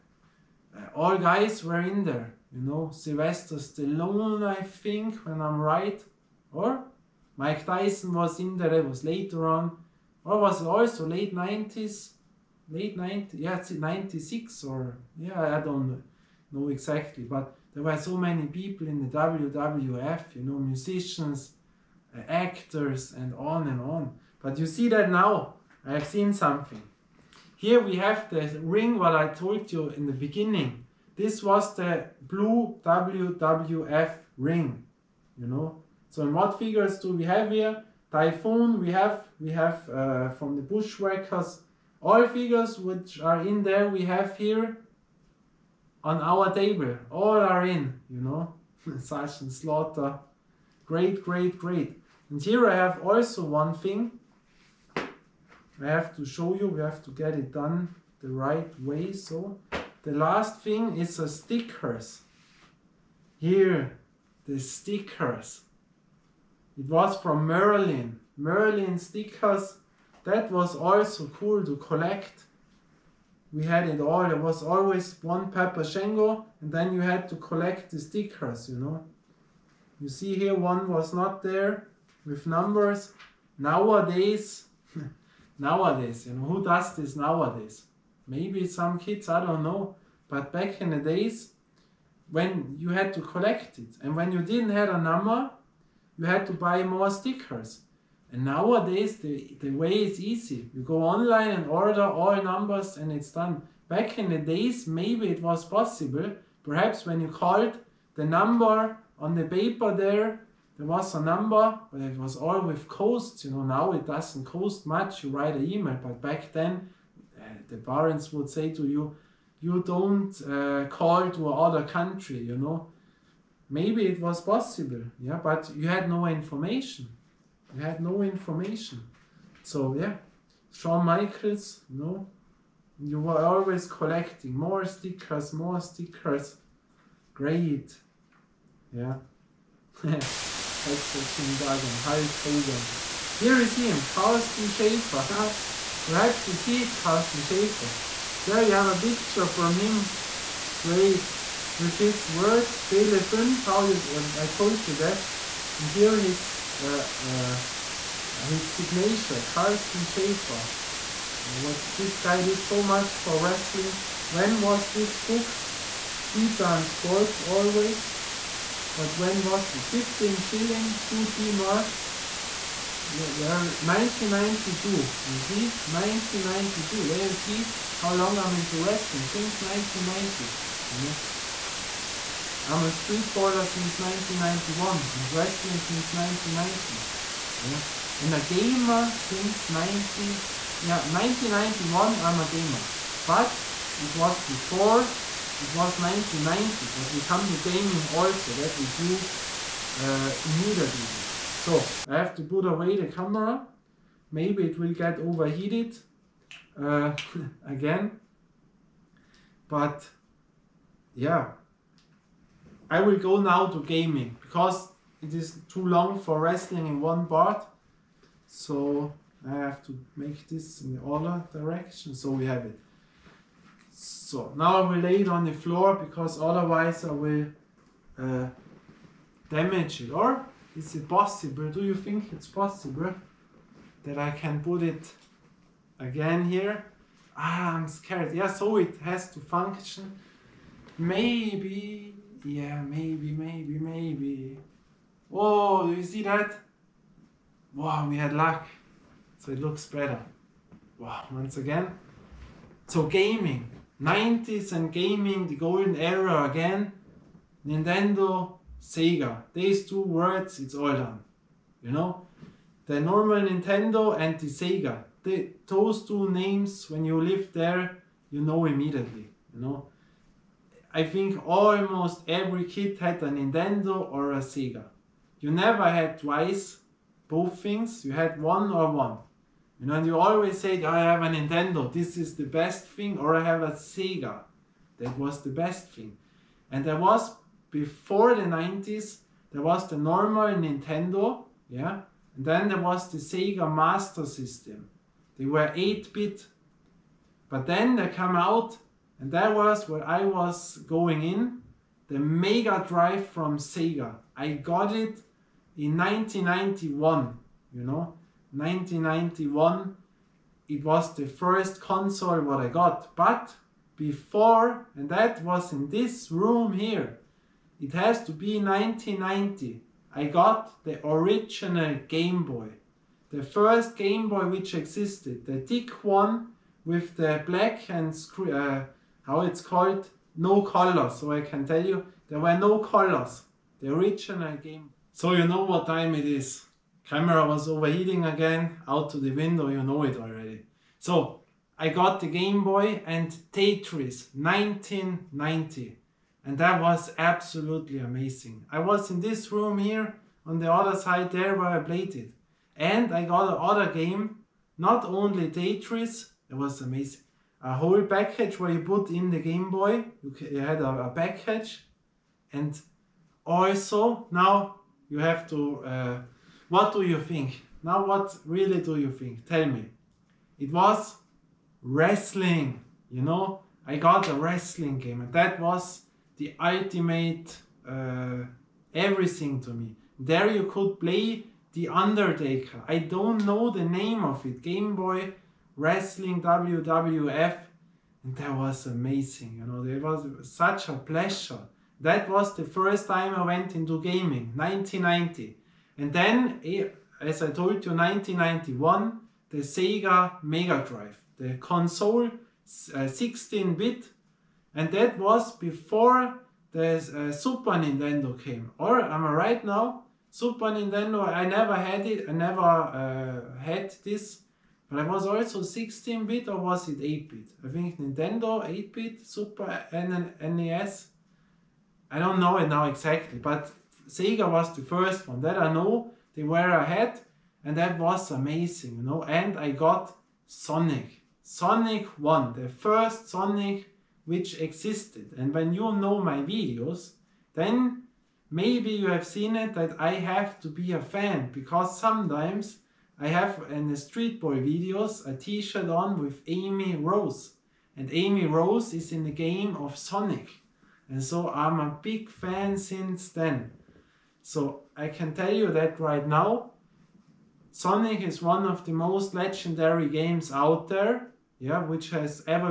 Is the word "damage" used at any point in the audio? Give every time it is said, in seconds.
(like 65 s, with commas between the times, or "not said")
229 s.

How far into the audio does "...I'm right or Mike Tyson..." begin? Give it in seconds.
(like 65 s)
5 s.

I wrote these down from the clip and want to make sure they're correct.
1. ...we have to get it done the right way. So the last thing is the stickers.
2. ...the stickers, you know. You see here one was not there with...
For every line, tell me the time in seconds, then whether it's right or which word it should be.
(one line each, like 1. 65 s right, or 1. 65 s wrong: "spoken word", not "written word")
1. 56 s right
2. 77 s right.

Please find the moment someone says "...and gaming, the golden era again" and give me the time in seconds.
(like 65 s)
254 s.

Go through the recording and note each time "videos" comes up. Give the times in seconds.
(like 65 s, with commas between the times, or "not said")
436 s, 444 s.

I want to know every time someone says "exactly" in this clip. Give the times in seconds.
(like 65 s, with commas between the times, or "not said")
16 s, 422 s.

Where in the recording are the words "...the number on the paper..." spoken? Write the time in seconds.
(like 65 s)
108 s.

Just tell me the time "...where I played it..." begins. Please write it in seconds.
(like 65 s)
351 s.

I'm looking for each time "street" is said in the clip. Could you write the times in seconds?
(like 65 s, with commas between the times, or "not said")
182 s, 443 s.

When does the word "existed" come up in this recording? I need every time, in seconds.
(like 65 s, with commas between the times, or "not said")
324 s, 434 s.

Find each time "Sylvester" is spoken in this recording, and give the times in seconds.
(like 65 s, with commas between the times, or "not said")
2 s.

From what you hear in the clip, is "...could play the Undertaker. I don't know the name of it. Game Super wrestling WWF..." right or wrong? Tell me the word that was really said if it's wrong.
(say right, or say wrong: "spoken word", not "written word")
wrong: "Boy", not "Super".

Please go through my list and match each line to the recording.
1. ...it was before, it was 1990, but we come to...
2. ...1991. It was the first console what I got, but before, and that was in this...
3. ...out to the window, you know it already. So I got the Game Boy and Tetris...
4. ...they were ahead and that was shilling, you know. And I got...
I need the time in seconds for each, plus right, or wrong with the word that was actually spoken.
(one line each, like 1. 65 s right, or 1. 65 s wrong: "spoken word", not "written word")
1. 193 s right
2. 308 s right
3. 338 s right
4. 426 s wrong: "amazing", not "shilling".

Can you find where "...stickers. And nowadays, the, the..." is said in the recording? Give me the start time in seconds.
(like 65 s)
97 s.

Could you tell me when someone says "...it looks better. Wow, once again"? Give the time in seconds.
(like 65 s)
249 s.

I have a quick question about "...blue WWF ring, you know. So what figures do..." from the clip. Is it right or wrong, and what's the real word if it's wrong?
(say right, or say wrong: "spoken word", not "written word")
right.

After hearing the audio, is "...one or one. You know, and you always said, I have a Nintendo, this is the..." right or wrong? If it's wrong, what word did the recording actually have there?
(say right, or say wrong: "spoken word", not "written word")
right.